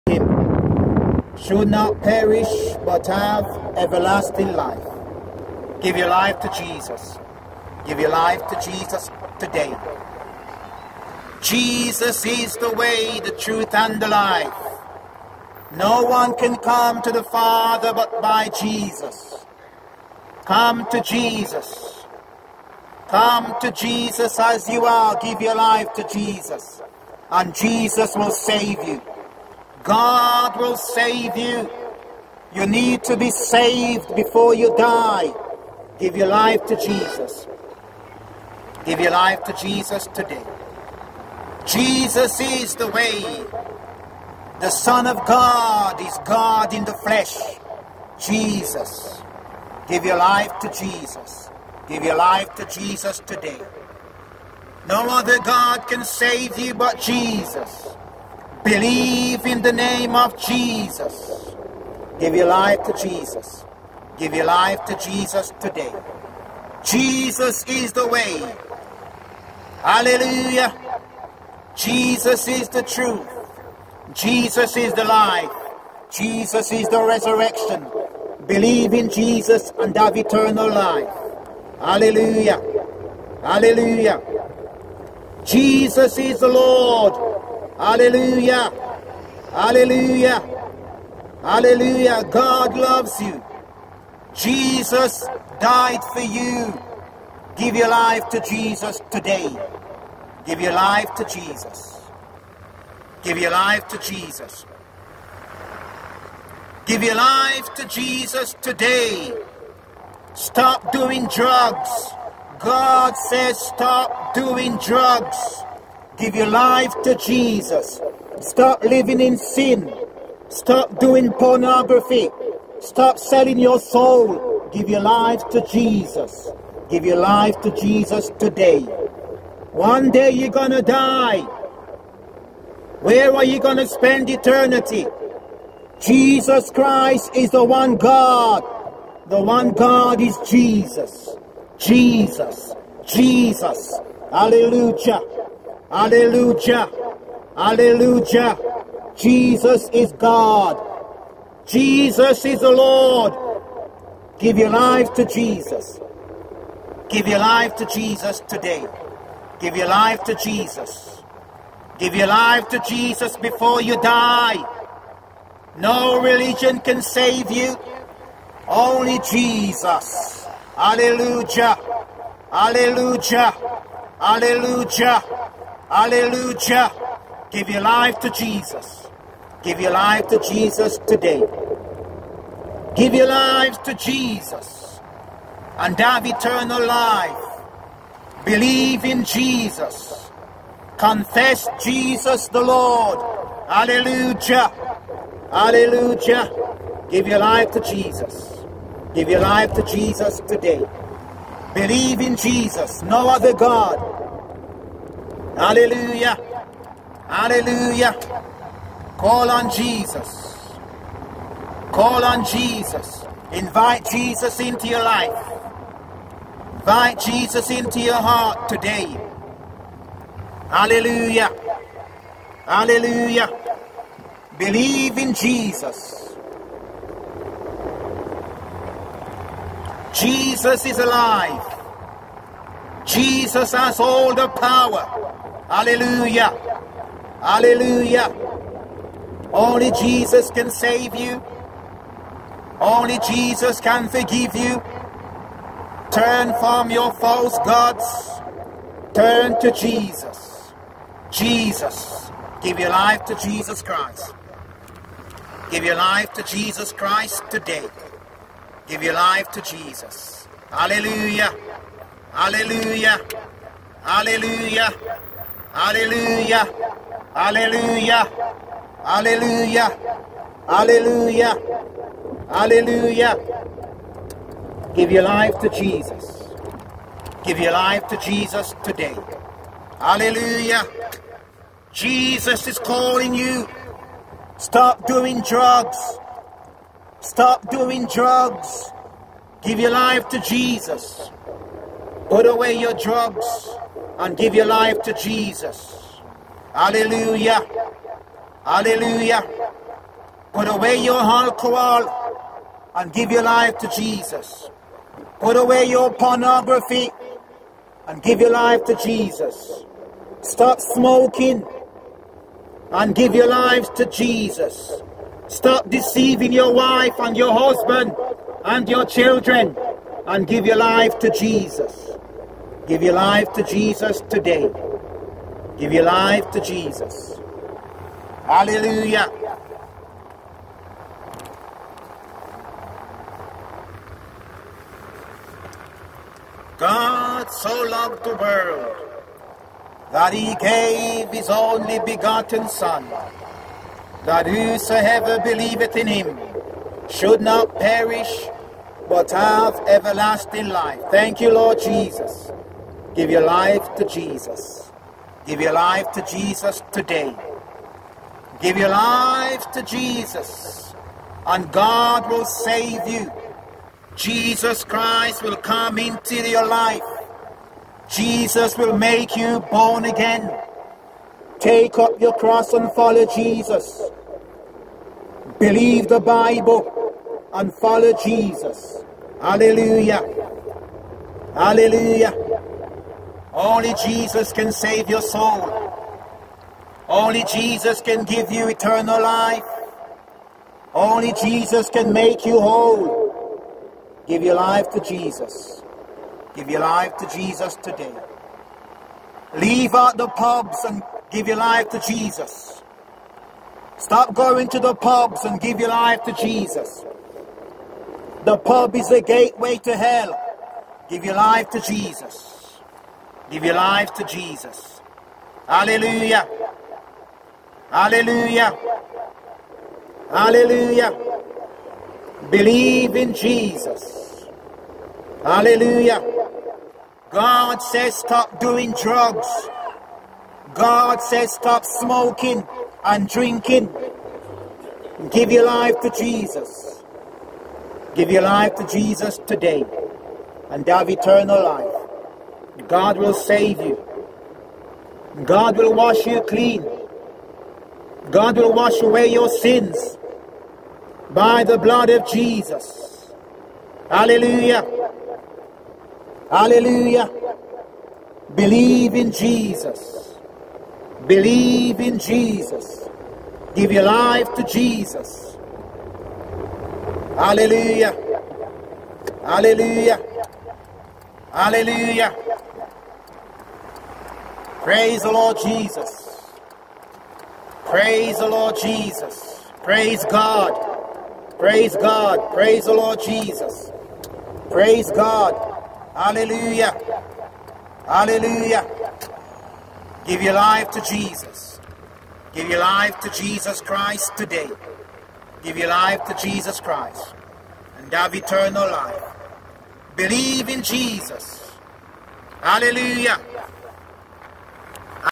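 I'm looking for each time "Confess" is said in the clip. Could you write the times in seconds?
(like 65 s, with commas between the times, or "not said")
190 s.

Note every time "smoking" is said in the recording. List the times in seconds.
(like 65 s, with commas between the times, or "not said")
310 s, 431 s.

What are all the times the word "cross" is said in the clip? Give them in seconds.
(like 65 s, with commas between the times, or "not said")
372 s.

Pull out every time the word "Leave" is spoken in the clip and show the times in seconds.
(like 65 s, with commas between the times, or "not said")
399 s.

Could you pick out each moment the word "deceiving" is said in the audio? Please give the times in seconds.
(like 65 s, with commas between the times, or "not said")
315 s.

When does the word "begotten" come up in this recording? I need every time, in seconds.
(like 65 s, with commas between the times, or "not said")
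342 s.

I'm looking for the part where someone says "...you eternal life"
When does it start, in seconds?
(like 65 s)
388 s.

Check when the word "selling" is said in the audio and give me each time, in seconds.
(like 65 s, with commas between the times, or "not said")
123 s.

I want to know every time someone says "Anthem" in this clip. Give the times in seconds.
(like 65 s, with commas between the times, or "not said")
not said.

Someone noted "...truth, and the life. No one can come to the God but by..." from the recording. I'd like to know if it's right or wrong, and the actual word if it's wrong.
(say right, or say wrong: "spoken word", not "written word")
wrong: "Father", not "God".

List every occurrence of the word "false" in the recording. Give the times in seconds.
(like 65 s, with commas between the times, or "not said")
247 s.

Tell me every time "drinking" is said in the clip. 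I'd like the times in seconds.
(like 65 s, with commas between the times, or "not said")
433 s.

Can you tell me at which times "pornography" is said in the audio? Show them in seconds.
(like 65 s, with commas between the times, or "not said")
121 s, 306 s.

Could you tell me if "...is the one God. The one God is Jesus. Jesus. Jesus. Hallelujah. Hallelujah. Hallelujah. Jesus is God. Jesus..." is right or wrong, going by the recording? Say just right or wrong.
right.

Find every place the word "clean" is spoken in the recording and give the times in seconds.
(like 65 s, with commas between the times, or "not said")
446 s.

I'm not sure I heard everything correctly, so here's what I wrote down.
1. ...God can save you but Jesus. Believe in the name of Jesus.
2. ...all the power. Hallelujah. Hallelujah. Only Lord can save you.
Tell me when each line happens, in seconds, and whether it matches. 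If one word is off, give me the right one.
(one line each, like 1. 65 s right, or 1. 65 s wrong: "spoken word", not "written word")
1. 55 s right
2. 233 s wrong: "Jesus", not "Lord".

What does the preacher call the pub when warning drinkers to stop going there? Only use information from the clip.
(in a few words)
the gateway to hell.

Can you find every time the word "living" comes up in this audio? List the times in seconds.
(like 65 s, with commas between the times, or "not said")
118 s.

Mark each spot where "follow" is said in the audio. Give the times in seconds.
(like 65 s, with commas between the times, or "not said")
372 s, 377 s.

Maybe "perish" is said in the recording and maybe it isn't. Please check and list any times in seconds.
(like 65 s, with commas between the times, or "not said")
2 s, 347 s.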